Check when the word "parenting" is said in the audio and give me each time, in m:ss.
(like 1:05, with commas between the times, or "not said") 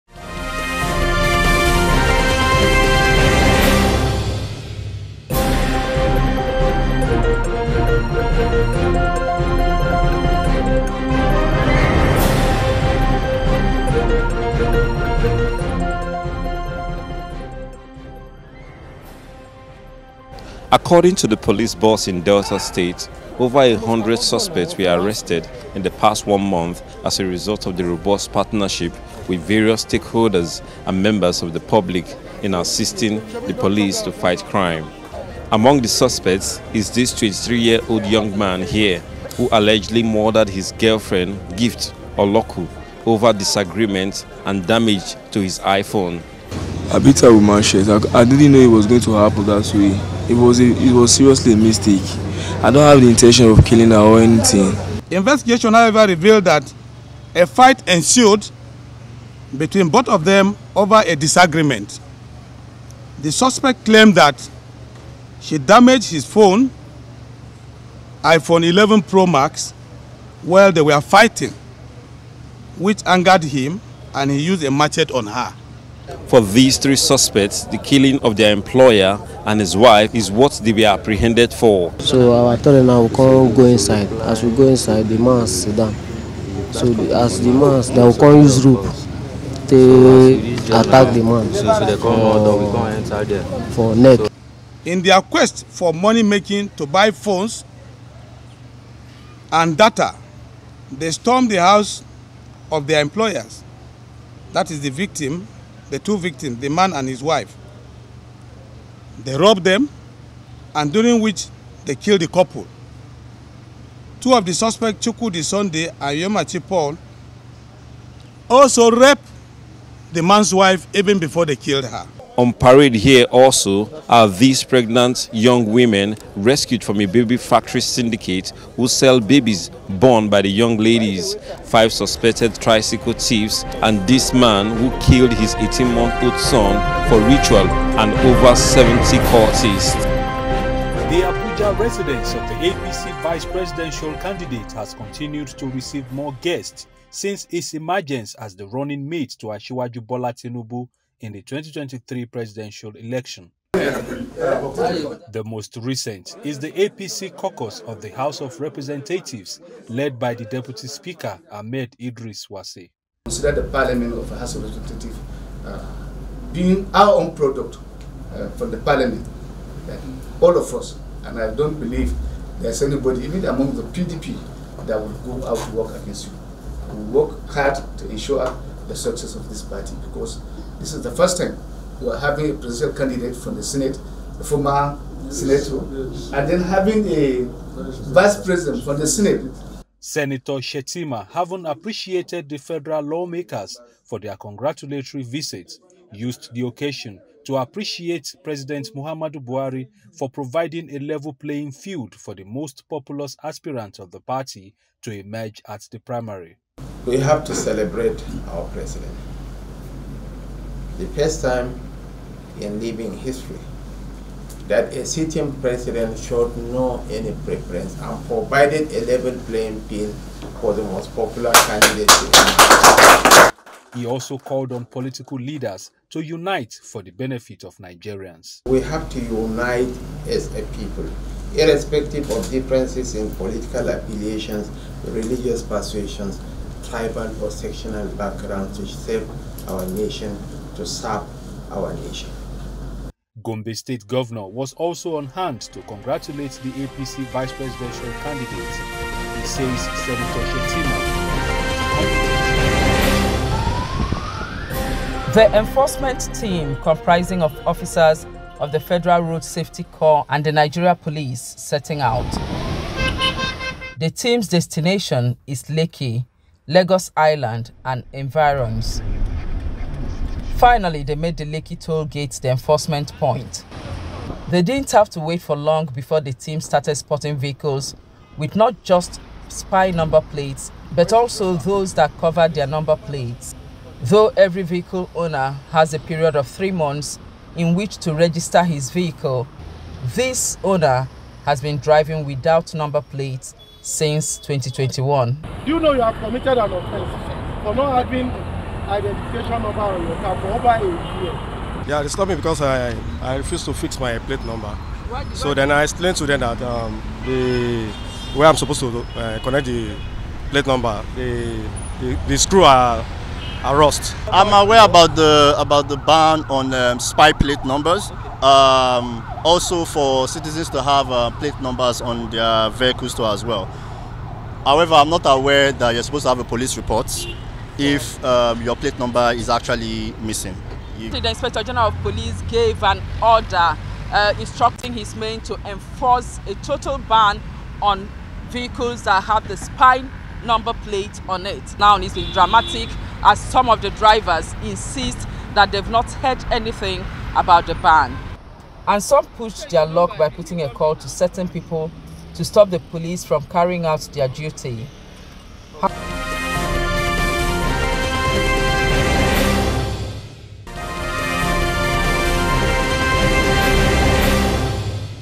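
not said.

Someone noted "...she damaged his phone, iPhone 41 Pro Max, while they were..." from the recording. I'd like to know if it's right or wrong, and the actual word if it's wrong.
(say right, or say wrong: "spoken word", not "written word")
wrong: "11", not "41".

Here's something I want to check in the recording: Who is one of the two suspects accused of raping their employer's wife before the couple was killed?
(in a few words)
Chukwudi Sunday.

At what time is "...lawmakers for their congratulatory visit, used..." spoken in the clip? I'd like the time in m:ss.
3:13.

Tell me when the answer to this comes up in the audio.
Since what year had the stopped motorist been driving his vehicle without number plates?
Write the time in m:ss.
4:54.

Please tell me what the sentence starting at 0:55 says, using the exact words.
Investigation, however, revealed that a fight ensued between both of them over a disagreement.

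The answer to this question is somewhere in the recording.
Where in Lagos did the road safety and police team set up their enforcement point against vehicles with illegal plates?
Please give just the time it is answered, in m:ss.
4:31.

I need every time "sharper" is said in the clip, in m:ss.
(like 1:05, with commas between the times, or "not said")
not said.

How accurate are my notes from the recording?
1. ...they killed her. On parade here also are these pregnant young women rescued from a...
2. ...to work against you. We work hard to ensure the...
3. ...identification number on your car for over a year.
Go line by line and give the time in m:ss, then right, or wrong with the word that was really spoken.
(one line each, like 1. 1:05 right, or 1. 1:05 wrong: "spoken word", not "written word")
1. 2:01 right
2. 2:55 right
3. 4:58 right.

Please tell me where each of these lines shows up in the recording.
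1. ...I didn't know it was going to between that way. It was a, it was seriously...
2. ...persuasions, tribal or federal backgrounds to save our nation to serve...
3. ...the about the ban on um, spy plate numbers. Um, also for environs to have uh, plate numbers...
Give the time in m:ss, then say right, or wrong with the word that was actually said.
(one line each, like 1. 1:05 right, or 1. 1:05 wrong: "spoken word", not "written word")
1. 0:48 wrong: "happen", not "between"
2. 3:55 wrong: "sectional", not "federal"
3. 5:15 wrong: "citizens", not "environs".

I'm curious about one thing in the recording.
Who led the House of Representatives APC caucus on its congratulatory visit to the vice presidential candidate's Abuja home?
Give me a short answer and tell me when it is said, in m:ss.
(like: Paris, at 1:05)
Ahmed Idris Wase, at 2:41.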